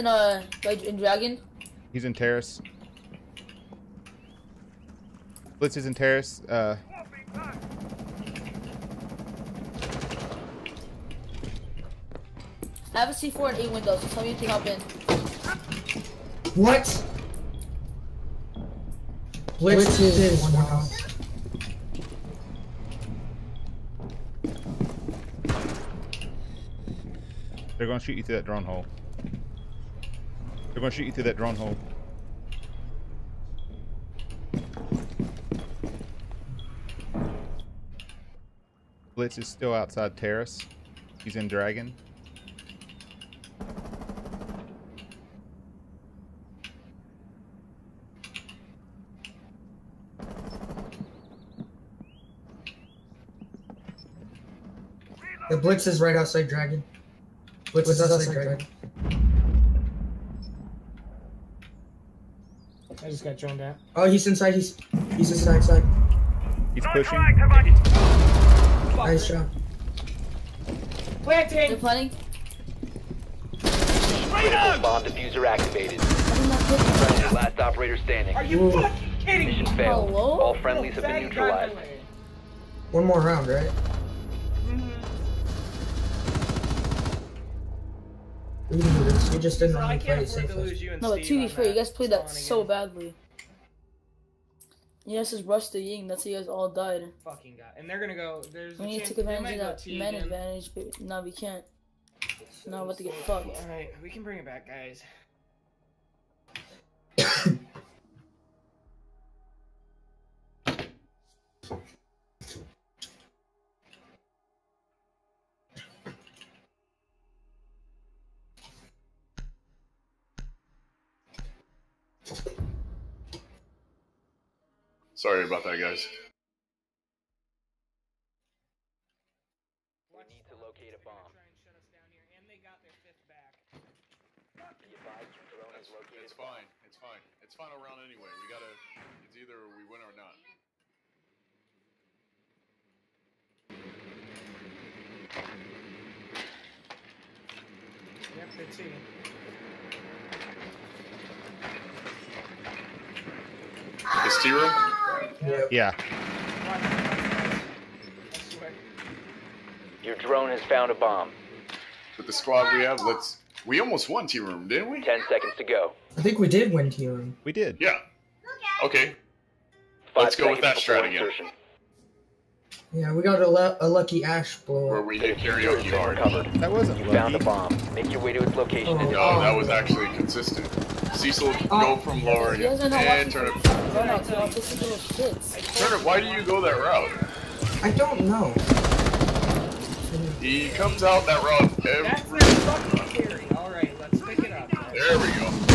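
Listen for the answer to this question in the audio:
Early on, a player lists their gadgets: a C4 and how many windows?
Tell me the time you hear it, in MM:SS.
00:13.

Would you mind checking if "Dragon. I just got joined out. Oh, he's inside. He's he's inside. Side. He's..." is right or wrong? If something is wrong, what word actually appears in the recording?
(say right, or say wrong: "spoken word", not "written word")
right.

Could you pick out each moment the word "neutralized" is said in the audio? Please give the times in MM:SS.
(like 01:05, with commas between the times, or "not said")
01:21.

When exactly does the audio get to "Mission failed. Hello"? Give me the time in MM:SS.
01:19.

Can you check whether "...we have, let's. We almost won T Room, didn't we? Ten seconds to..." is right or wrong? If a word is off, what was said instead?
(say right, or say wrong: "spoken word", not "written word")
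right.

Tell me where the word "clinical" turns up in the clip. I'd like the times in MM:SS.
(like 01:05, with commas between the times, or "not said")
not said.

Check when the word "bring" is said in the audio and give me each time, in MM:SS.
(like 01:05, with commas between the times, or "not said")
01:44.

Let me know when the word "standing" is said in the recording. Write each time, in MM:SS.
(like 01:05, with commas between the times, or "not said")
01:17.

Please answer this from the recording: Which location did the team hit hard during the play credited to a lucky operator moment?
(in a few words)
karaoke.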